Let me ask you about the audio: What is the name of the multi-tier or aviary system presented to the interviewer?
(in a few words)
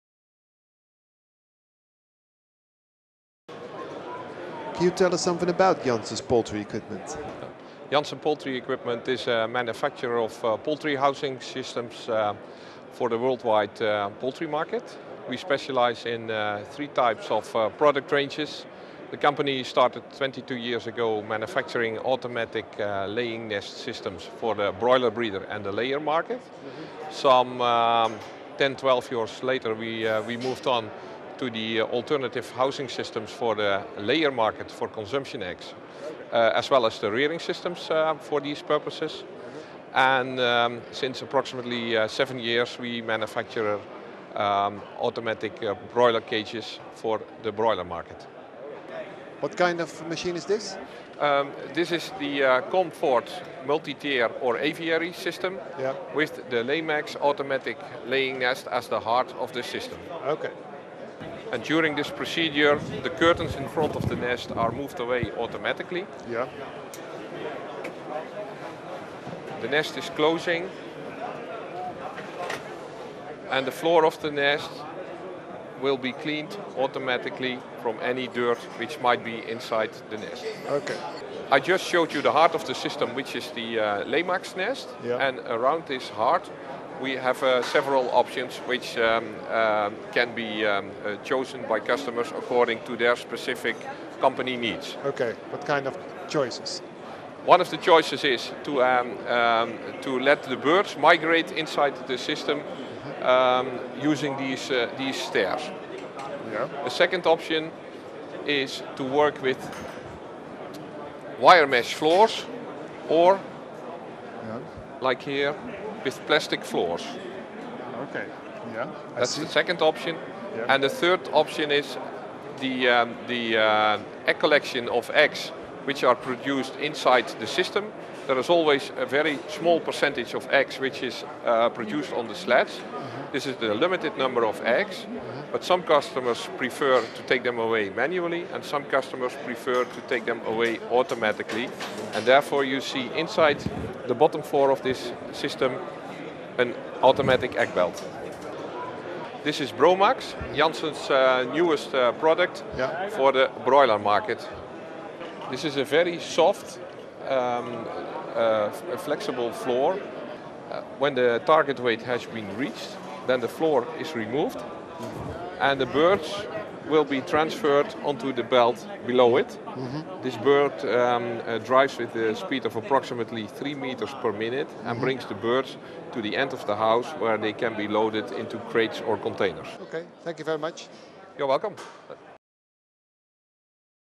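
Comfort.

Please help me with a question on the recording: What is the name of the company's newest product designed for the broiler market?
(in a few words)
Bromax.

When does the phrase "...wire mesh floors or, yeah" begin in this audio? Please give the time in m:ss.
1:51.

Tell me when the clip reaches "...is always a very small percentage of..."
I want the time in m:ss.
2:08.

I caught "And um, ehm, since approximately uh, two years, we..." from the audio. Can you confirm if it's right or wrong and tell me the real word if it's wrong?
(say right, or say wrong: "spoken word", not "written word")
wrong: "seven", not "two".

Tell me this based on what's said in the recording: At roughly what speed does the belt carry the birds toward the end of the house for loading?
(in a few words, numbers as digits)
3 meters per minute.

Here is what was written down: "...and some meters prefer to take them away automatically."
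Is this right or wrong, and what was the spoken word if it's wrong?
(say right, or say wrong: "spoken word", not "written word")
wrong: "customers", not "meters".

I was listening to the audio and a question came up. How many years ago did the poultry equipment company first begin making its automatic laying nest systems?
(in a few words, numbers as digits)
22 years.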